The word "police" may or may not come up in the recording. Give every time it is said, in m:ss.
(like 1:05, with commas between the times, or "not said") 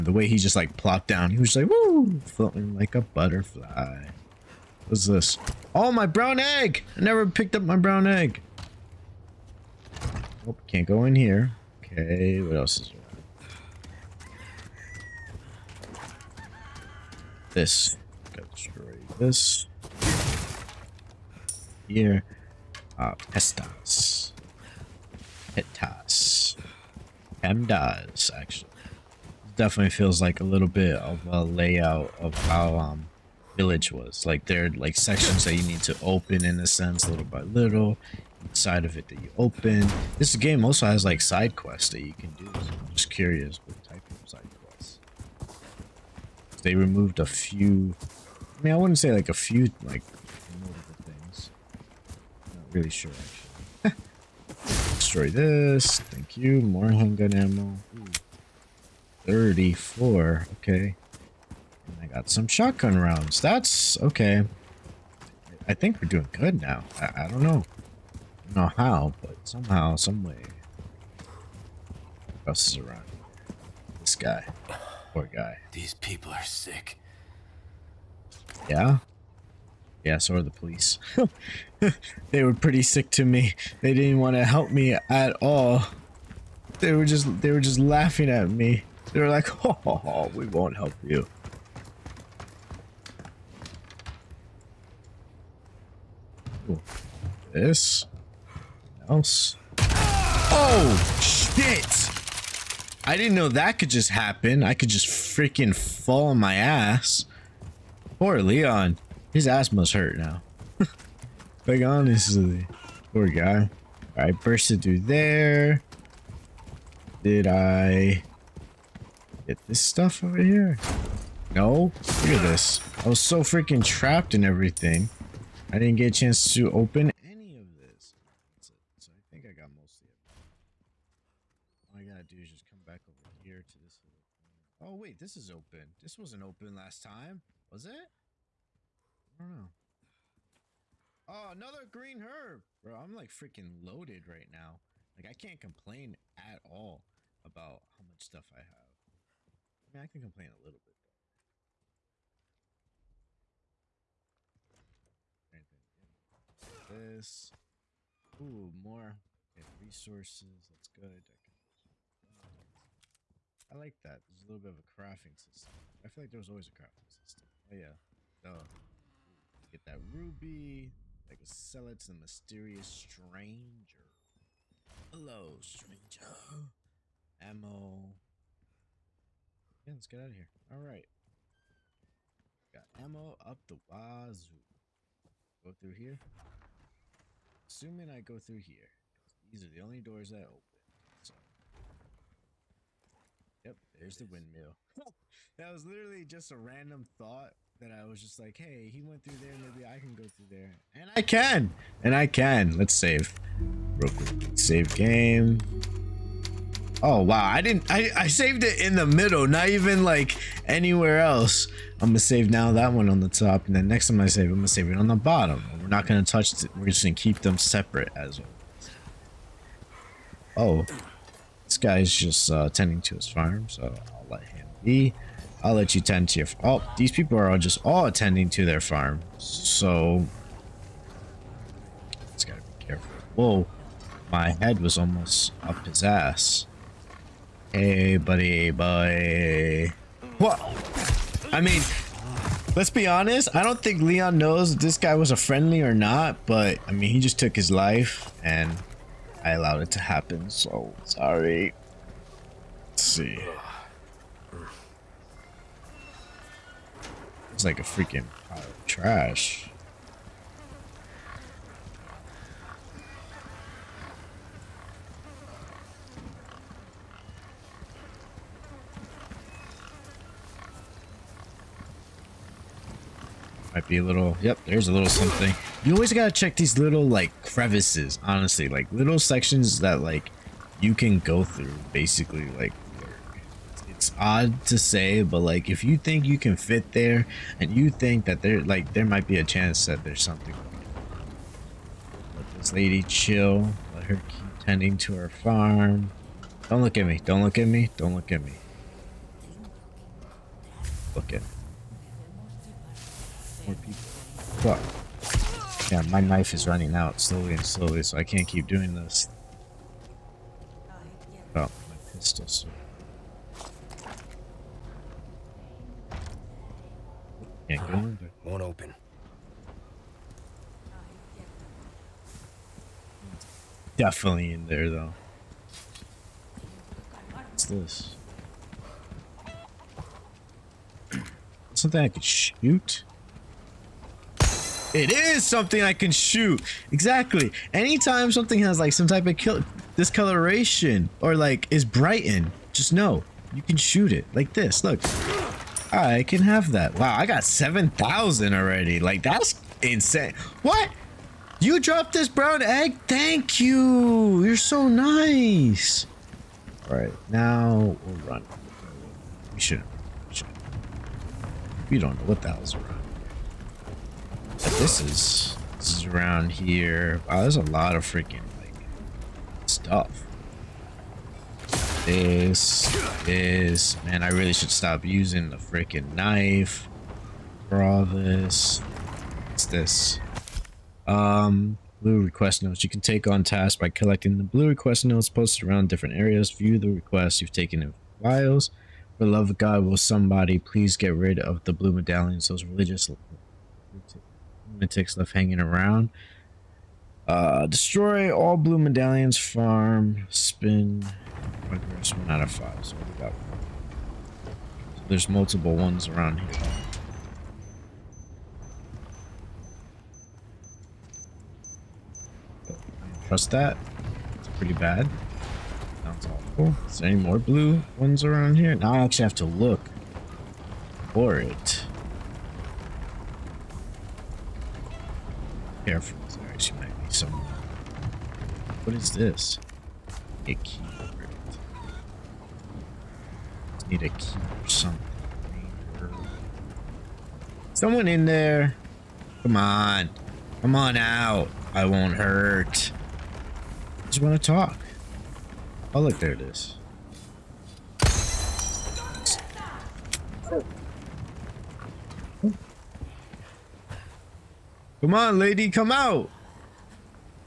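1:20.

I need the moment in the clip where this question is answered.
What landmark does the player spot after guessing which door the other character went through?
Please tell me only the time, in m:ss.
3:14.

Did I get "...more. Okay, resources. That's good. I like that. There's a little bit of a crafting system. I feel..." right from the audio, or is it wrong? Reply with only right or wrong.
right.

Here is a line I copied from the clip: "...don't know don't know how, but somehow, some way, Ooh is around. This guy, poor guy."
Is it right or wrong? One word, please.
wrong.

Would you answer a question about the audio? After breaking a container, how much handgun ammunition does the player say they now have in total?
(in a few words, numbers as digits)
34.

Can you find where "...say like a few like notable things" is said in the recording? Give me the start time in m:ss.
0:48.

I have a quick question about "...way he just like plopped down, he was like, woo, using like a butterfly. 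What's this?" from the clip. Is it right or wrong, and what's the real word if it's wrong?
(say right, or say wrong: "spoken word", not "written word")
wrong: "floating", not "using".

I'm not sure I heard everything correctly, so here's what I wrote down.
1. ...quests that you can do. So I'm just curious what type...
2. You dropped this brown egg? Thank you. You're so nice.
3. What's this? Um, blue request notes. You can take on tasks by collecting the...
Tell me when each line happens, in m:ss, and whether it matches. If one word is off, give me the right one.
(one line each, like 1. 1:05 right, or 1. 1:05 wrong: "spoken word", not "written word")
1. 0:41 right
2. 5:51 right
3. 6:19 right.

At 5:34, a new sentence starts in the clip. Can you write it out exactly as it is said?
It is something I can shoot.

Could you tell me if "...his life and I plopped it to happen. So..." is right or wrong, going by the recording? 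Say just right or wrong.
wrong.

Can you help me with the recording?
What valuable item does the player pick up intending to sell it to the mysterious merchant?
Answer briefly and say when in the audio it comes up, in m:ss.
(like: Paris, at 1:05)
ruby, at 2:50.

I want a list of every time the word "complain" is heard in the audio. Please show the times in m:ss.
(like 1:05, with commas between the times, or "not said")
2:25, 2:30.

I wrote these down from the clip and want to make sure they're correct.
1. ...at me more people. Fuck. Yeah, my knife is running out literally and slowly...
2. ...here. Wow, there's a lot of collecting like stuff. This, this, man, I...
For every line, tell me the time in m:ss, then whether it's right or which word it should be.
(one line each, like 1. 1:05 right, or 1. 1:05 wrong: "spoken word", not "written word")
1. 5:01 wrong: "slowly", not "literally"
2. 6:06 wrong: "freaking", not "collecting".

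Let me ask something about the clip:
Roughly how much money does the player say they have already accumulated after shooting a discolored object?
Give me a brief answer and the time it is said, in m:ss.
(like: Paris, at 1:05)
7,000, at 5:47.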